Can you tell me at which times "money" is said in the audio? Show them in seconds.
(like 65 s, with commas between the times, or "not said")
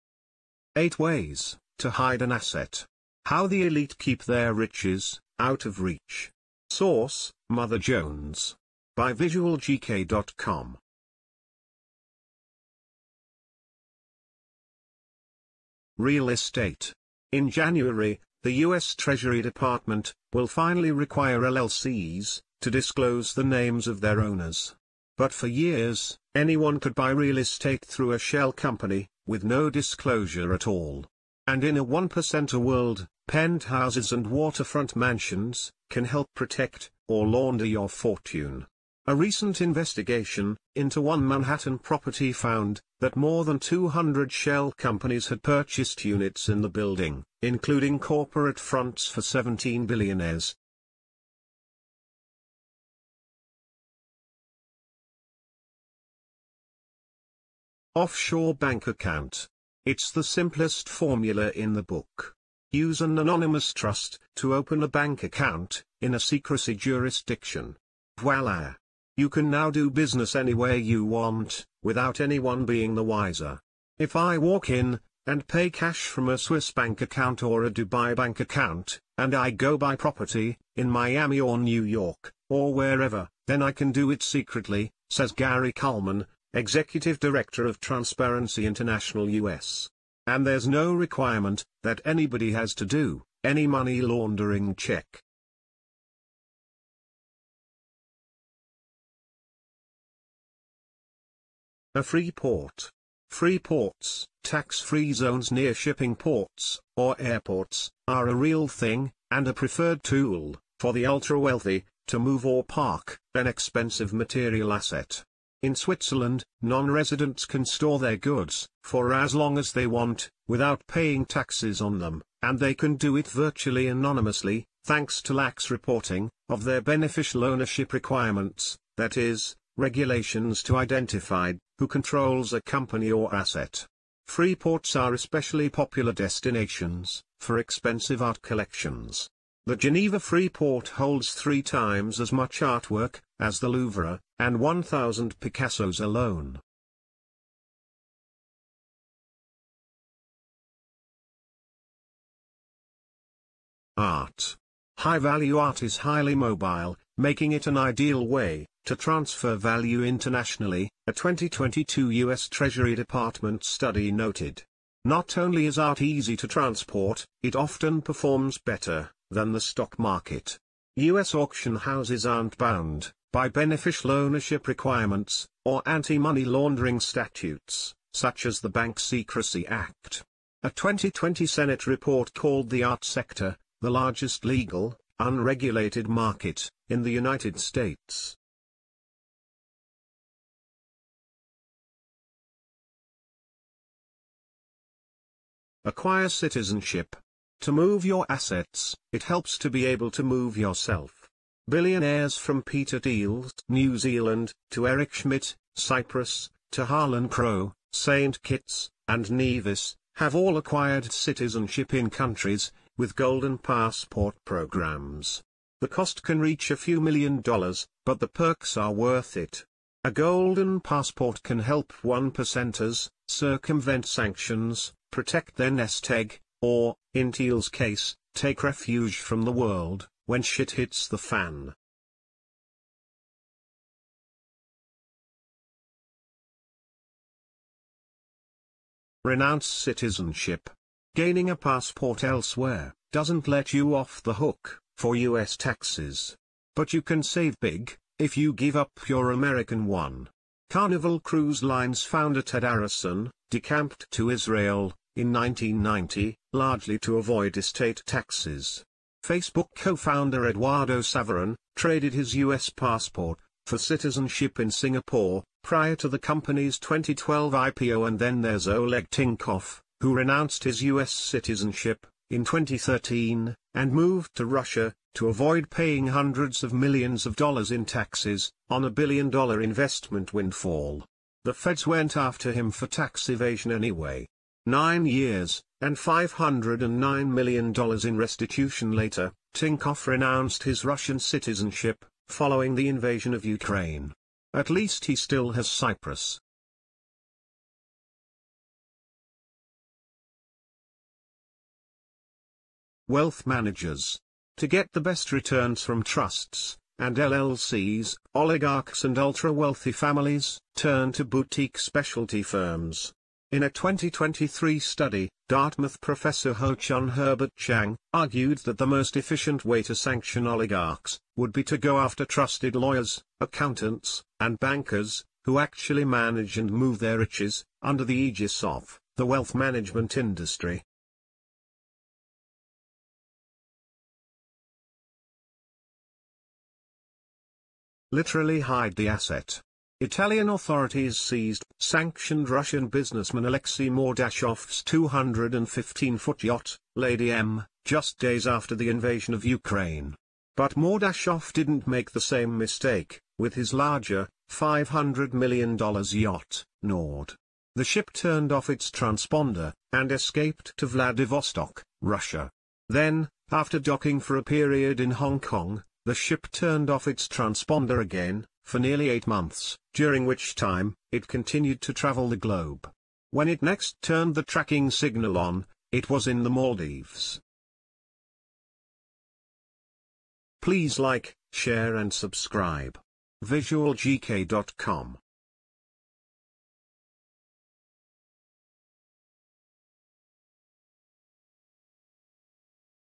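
93 s, 175 s.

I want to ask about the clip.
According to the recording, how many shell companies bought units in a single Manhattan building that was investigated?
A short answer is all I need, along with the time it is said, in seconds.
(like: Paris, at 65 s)
more than 200, at 43 s.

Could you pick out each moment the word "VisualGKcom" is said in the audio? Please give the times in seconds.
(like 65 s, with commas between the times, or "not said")
9 s, 383 s.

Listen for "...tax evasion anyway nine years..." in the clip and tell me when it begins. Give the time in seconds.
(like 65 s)
282 s.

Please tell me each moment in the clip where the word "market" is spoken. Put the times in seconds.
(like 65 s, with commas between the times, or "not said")
169 s, 186 s.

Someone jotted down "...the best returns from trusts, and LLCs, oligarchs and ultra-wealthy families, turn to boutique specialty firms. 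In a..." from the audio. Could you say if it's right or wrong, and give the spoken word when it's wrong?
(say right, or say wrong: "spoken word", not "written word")
right.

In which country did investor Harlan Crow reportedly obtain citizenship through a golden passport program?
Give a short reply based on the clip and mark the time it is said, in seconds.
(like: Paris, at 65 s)
St. Kitts and Nevis, at 207 s.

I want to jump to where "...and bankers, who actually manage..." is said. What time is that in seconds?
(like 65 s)
324 s.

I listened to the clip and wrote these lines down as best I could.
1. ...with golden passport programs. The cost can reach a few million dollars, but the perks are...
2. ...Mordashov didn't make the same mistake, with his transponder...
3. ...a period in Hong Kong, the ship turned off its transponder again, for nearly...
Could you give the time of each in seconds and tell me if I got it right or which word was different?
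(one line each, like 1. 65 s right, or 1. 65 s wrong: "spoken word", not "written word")
1. 212 s right
2. 350 s wrong: "larger", not "transponder"
3. 364 s right.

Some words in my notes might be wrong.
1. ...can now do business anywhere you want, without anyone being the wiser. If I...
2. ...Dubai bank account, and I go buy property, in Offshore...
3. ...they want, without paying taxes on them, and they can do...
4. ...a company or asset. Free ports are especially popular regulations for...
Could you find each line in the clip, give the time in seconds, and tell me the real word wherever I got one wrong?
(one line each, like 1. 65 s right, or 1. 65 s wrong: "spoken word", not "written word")
1. 69 s right
2. 77 s wrong: "Miami", not "Offshore"
3. 119 s right
4. 132 s wrong: "destinations", not "regulations".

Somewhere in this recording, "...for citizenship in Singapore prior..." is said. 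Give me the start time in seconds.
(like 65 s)
263 s.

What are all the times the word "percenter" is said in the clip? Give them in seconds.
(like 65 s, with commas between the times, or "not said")
31 s, 222 s.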